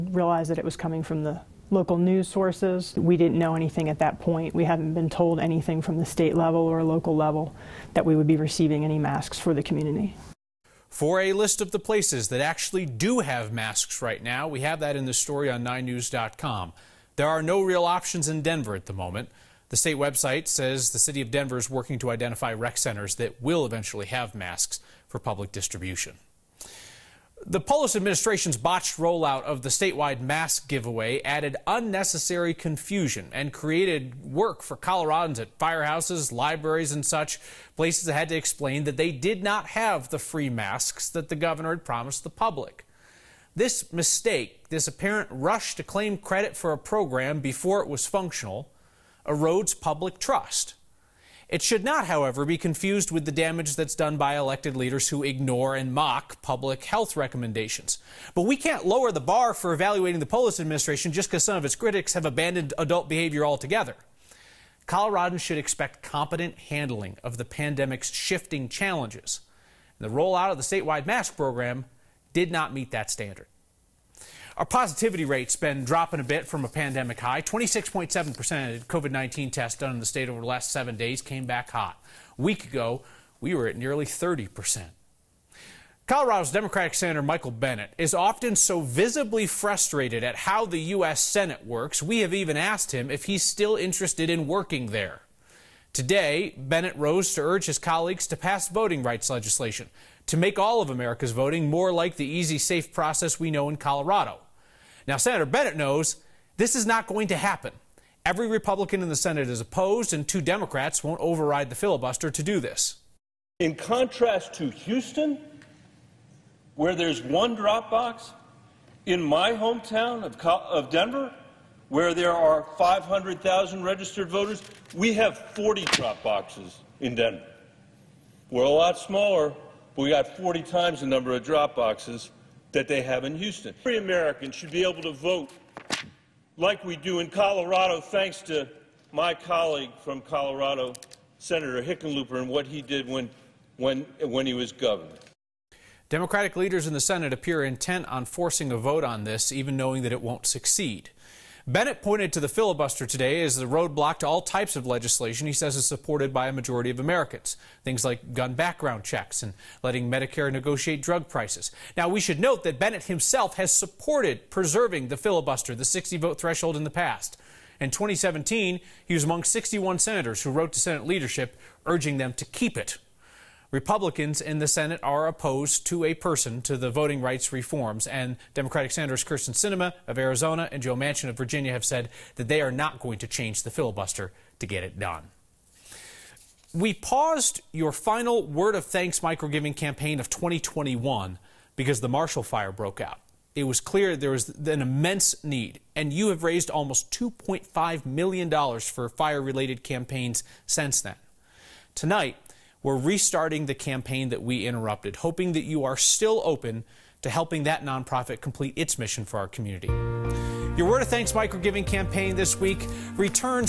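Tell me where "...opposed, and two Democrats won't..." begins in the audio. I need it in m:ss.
1:49.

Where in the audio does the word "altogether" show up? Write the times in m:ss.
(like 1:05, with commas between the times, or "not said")
1:03.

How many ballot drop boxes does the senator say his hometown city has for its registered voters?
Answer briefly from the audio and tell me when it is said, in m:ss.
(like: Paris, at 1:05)
40, at 2:05.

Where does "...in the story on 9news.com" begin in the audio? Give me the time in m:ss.
0:14.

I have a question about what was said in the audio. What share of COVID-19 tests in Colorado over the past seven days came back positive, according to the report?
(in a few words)
26.7%.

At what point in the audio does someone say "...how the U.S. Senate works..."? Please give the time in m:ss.
1:30.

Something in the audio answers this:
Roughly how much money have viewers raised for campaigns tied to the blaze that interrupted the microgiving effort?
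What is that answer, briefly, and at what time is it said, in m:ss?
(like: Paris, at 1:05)
$2.5 million, at 3:17.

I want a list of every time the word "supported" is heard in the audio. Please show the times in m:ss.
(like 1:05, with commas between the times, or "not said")
2:35, 2:43.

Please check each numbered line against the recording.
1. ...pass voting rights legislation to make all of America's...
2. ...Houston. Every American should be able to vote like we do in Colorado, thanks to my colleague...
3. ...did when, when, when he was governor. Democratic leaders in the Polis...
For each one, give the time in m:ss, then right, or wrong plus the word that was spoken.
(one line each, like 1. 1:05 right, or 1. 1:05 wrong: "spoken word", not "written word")
1. 1:38 right
2. 2:13 right
3. 2:22 wrong: "Senate", not "Polis".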